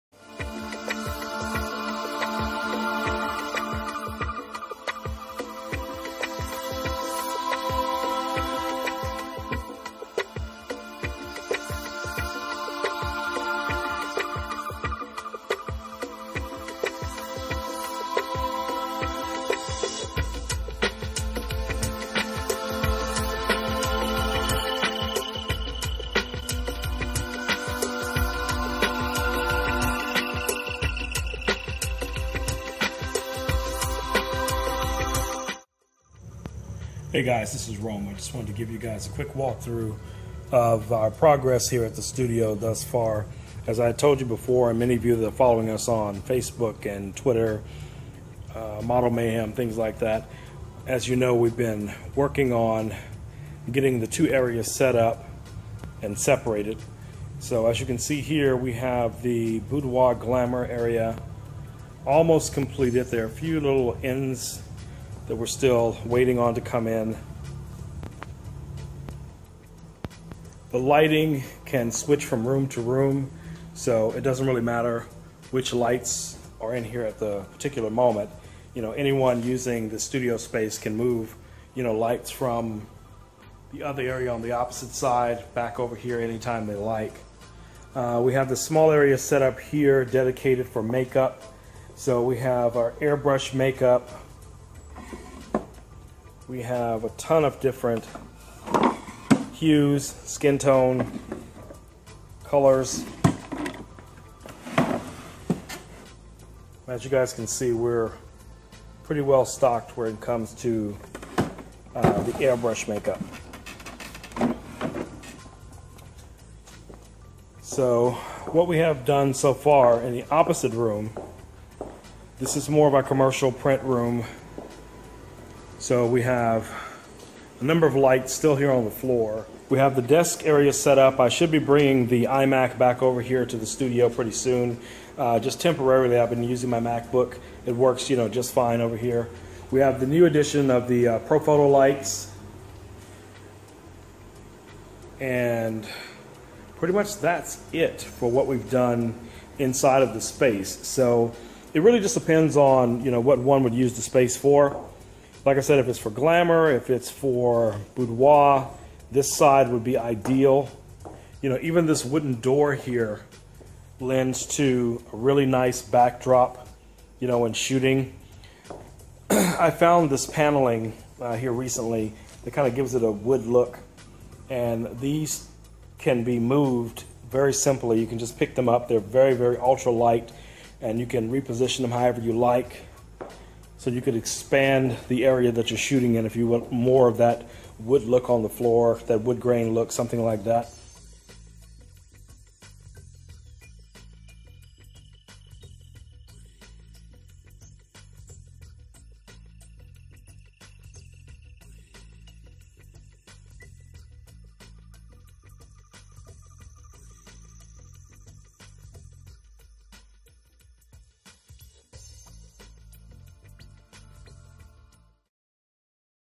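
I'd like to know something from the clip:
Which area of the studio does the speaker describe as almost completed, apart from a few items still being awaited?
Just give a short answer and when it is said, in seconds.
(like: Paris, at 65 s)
Boudoir Glamour area, at 59 s.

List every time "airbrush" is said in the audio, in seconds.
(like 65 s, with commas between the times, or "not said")
92 s, 112 s.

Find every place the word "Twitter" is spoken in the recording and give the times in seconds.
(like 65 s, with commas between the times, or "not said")
47 s.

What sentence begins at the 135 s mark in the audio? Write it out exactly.
Uh, just temporarily, I've been using my MacBook.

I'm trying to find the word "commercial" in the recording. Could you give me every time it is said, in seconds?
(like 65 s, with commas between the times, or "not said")
123 s.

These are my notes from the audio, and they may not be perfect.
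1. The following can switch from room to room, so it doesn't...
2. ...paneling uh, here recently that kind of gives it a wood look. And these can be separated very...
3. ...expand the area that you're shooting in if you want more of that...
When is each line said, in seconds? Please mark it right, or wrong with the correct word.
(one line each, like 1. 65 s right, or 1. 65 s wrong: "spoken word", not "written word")
1. 70 s wrong: "lighting", not "following"
2. 170 s wrong: "moved", not "separated"
3. 184 s right.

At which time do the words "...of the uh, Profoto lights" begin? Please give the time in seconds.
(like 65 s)
140 s.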